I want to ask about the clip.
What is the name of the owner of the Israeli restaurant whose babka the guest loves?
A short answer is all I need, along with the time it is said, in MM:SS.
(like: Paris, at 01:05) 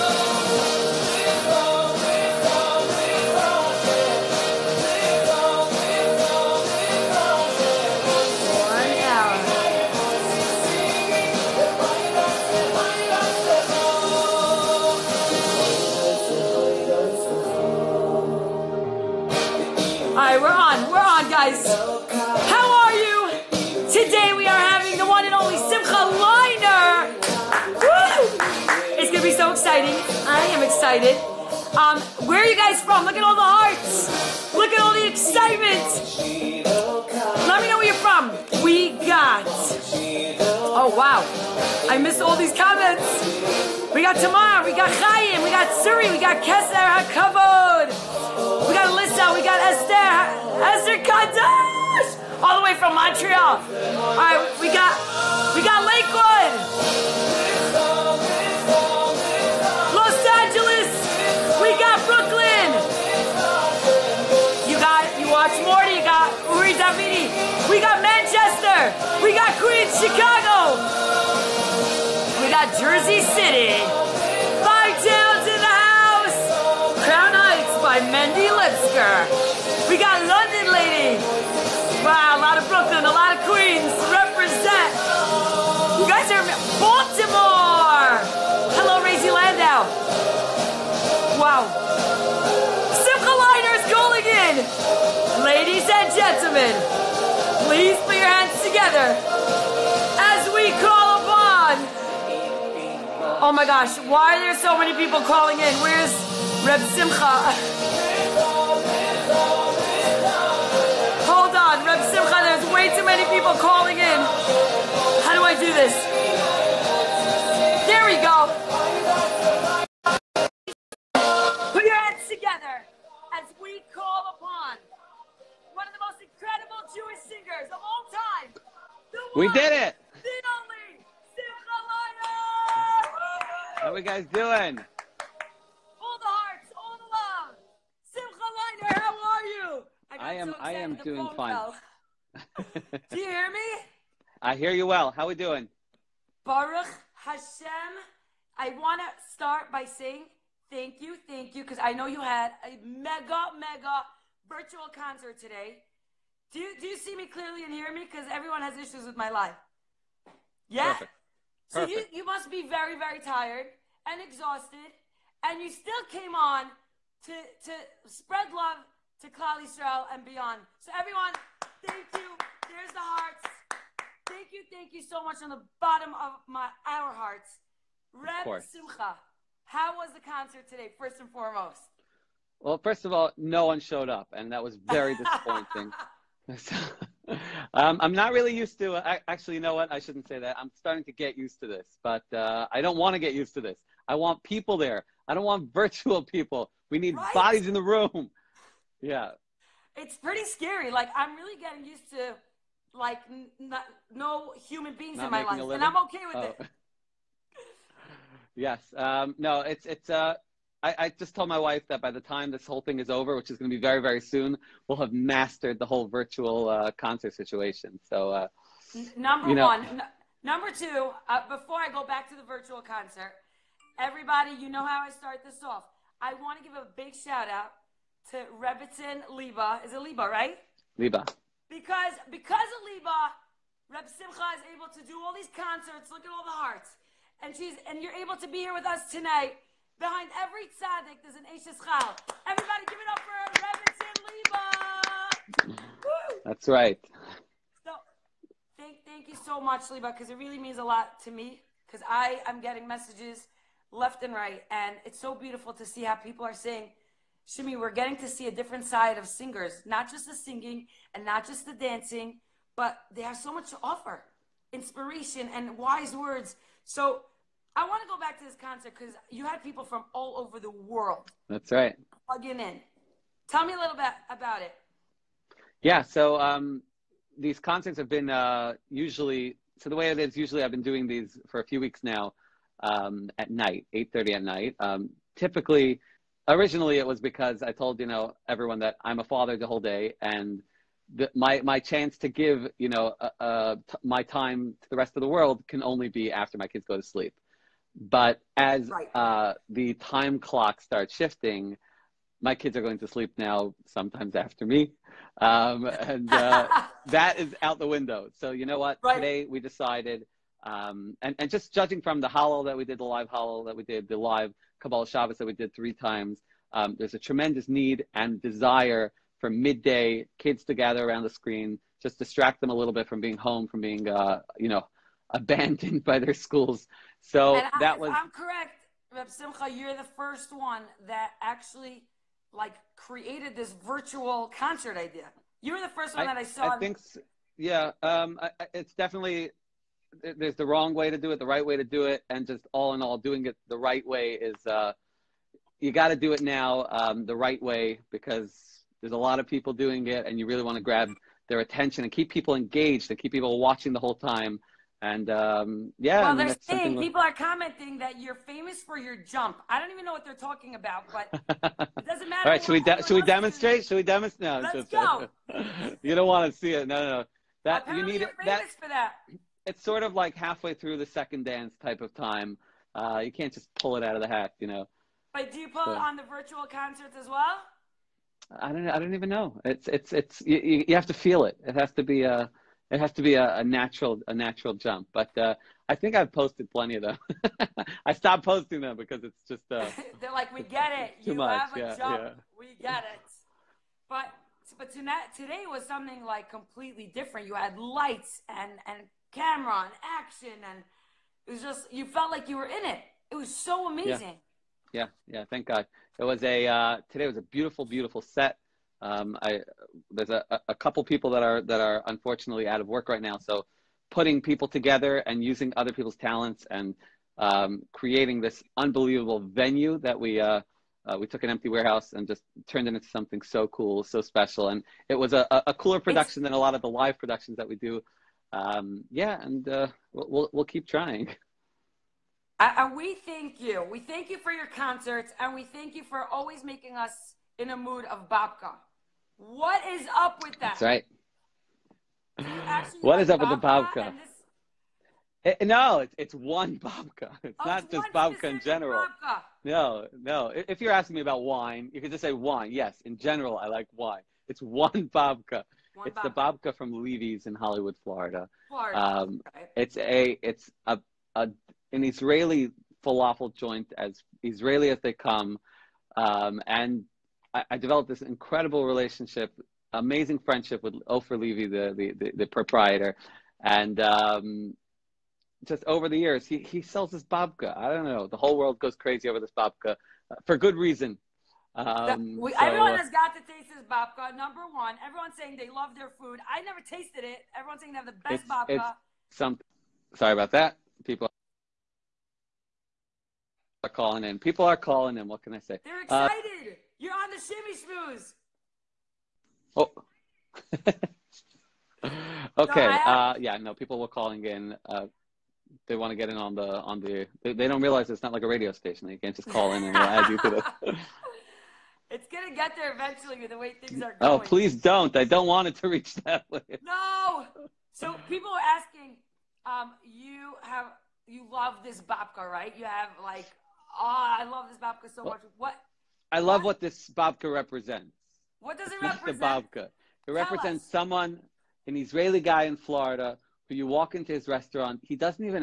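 Ofer Levy, at 07:51.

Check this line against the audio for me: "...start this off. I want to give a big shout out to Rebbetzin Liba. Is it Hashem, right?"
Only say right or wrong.
wrong.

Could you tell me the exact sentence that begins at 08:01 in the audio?
Um, we, so, everyone uh, has got to taste this babka.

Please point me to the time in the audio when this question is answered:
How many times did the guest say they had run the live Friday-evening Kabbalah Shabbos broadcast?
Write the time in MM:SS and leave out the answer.
05:15.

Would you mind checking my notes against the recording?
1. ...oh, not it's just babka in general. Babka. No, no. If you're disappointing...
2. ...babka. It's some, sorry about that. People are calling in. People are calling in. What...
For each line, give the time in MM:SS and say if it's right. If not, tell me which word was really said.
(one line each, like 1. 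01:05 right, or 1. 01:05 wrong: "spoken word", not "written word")
1. 07:27 wrong: "asking", not "disappointing"
2. 08:08 right.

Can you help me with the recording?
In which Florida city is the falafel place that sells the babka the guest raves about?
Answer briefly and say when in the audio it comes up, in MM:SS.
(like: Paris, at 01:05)
Hollywood, at 07:37.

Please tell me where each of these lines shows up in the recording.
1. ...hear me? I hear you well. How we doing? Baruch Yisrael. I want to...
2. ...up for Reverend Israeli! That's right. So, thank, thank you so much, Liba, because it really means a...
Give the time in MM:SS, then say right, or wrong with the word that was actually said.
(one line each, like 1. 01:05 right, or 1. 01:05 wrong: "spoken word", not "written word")
1. 02:23 wrong: "Hashem", not "Yisrael"
2. 04:03 wrong: "Liba", not "Israeli".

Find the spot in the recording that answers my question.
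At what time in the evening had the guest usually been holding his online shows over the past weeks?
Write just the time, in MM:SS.
04:43.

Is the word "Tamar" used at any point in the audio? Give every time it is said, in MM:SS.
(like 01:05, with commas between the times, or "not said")
00:44.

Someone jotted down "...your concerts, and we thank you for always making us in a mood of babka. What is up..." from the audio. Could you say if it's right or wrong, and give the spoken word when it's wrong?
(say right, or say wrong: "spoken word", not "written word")
right.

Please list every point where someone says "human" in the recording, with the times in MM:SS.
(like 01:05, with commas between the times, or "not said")
03:24.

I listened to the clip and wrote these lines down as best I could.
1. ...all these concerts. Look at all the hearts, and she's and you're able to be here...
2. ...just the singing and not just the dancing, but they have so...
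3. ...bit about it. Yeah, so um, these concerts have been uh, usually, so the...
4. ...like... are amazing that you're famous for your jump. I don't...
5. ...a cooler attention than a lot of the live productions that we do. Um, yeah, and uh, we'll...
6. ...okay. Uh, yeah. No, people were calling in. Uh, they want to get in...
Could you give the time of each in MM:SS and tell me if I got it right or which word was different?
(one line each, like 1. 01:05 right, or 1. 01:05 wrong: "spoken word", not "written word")
1. 03:55 right
2. 04:20 right
3. 04:33 right
4. 05:57 wrong: "commenting", not "amazing"
5. 07:05 wrong: "production", not "attention"
6. 08:22 right.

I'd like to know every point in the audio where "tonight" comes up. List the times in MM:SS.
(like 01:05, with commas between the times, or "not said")
03:59, 06:34.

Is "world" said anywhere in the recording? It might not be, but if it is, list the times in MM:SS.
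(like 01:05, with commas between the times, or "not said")
04:30, 04:55, 07:58.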